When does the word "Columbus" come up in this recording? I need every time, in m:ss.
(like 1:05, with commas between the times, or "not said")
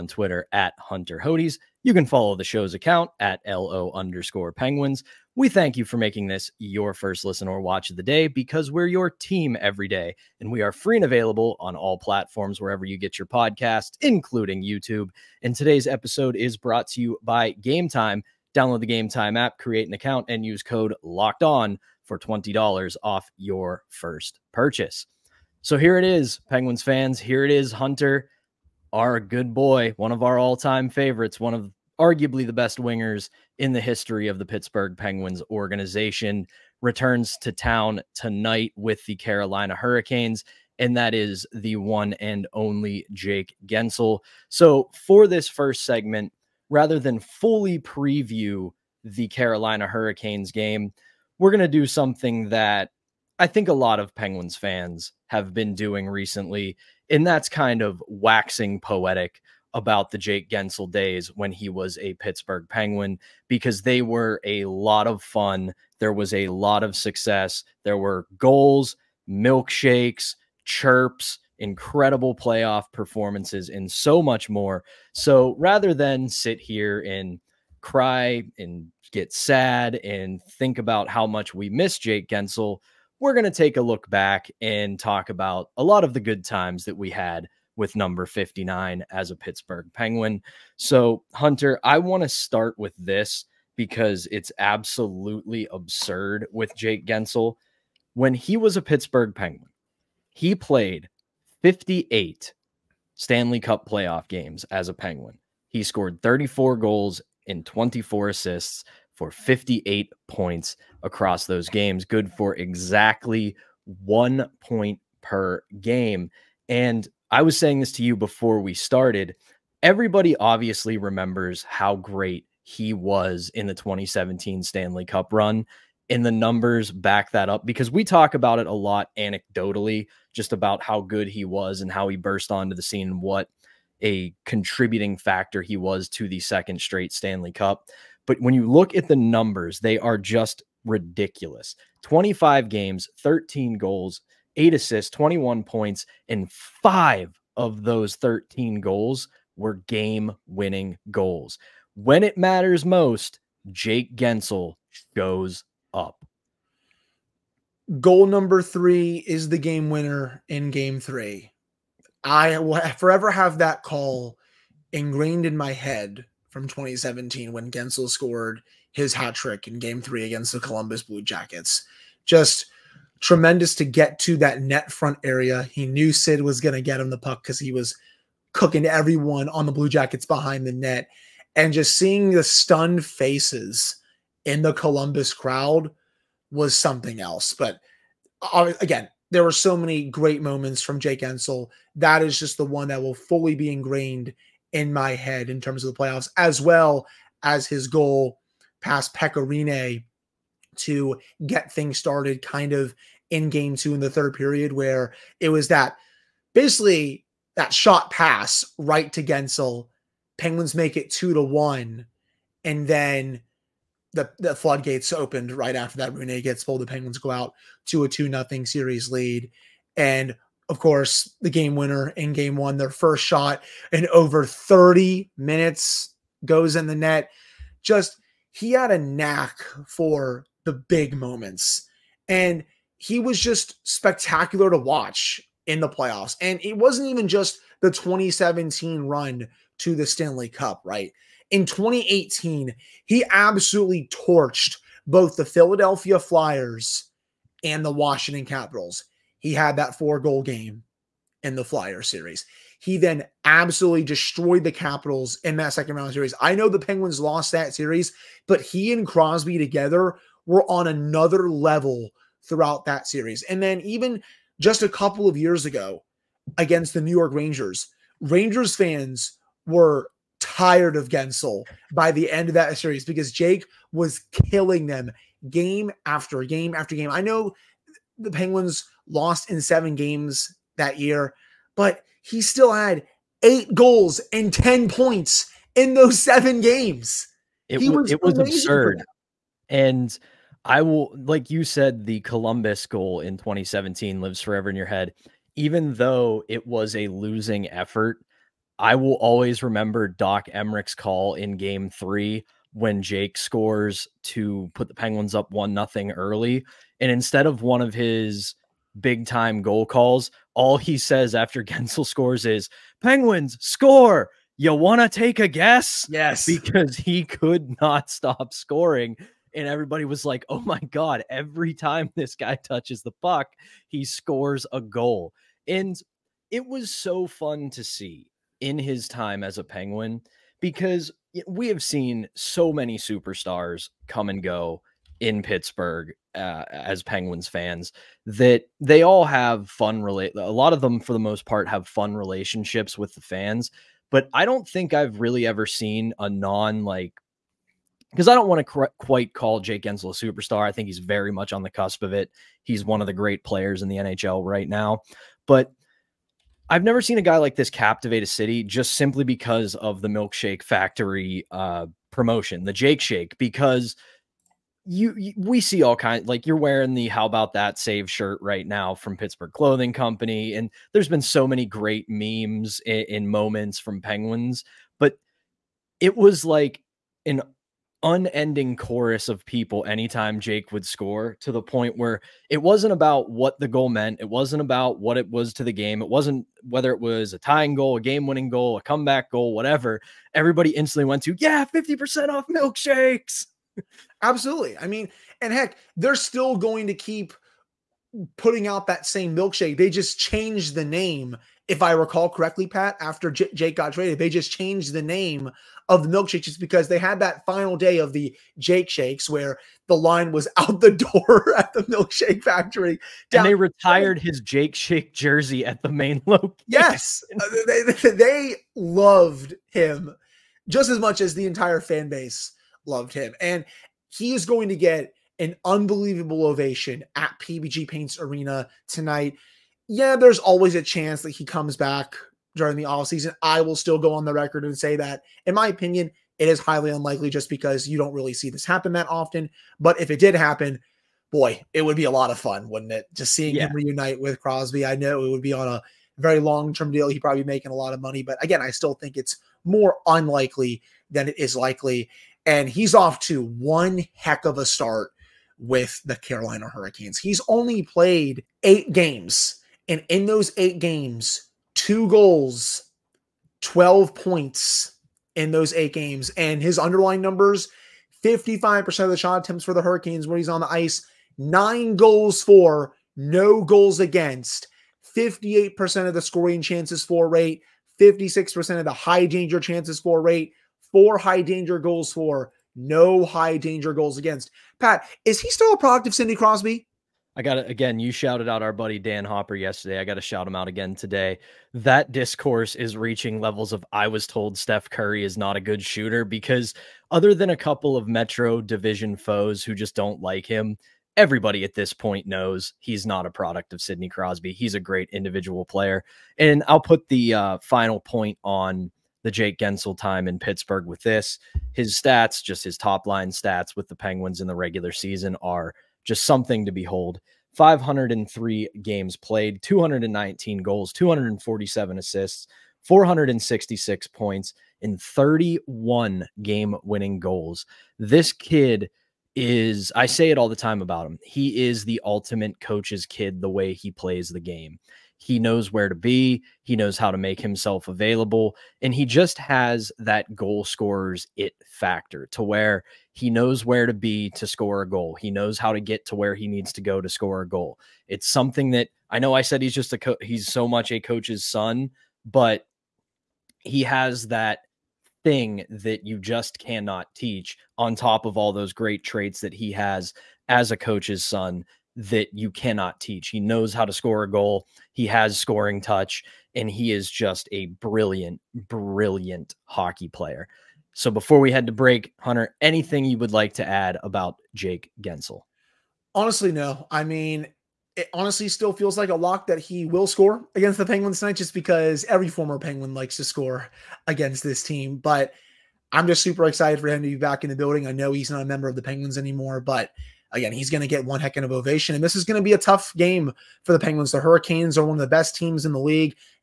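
2:50, 3:04, 4:52.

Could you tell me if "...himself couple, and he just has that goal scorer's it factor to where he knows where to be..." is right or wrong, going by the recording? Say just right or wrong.
wrong.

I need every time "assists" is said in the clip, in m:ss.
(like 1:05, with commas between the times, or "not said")
1:48, 2:24, 8:41.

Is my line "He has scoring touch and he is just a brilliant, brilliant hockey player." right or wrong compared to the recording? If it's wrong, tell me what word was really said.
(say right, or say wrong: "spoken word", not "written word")
right.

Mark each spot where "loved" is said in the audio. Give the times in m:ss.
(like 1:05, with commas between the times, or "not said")
6:58, 7:02.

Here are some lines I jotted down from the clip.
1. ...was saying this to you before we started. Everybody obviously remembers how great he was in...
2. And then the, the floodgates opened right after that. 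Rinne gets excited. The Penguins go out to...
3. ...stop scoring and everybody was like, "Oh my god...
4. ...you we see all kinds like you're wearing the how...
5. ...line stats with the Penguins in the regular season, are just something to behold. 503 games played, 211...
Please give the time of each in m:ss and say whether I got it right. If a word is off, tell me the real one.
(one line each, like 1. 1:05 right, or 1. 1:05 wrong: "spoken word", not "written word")
1. 1:57 right
2. 3:32 wrong: "pulled", not "excited"
3. 5:18 right
4. 6:05 right
5. 8:33 wrong: "219", not "211".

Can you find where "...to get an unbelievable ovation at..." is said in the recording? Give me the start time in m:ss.
7:04.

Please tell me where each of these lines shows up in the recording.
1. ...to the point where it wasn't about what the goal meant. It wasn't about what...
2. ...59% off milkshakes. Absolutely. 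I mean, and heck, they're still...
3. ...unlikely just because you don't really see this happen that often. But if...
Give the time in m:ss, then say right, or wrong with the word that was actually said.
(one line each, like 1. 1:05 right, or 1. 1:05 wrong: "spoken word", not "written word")
1. 6:21 right
2. 6:31 wrong: "50", not "59"
3. 7:16 right.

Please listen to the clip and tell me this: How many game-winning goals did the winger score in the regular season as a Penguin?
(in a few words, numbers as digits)
31.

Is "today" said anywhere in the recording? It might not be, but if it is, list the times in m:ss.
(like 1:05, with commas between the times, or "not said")
0:15, 8:10.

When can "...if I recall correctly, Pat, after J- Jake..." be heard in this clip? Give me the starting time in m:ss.
6:41.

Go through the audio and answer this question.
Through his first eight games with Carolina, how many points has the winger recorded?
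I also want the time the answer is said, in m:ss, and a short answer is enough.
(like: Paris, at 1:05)
12, at 7:43.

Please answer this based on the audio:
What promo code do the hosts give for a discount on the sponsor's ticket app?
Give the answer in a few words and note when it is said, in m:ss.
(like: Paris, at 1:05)
LOCKED ON, at 0:21.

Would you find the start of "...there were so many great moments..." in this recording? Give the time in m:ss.
3:09.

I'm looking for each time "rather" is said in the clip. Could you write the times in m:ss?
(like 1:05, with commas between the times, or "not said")
0:46, 1:15.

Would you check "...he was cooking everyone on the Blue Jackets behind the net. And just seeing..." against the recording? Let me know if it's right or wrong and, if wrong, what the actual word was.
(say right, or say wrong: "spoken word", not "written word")
right.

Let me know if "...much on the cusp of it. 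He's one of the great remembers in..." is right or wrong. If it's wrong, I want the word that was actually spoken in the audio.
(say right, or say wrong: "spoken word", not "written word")
wrong: "players", not "remembers".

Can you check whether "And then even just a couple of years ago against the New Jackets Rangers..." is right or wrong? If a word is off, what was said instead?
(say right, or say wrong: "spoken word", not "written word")
wrong: "York", not "Jackets".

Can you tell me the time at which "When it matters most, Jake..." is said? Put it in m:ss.
2:31.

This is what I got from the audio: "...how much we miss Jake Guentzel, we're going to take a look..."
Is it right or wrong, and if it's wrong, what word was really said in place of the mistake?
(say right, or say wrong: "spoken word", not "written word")
right.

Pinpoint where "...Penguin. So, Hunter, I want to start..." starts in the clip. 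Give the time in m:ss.
1:29.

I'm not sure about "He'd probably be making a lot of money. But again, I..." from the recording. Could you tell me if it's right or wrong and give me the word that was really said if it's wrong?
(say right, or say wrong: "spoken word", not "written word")
right.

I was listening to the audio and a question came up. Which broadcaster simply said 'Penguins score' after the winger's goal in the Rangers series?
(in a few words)
Doc Emrick.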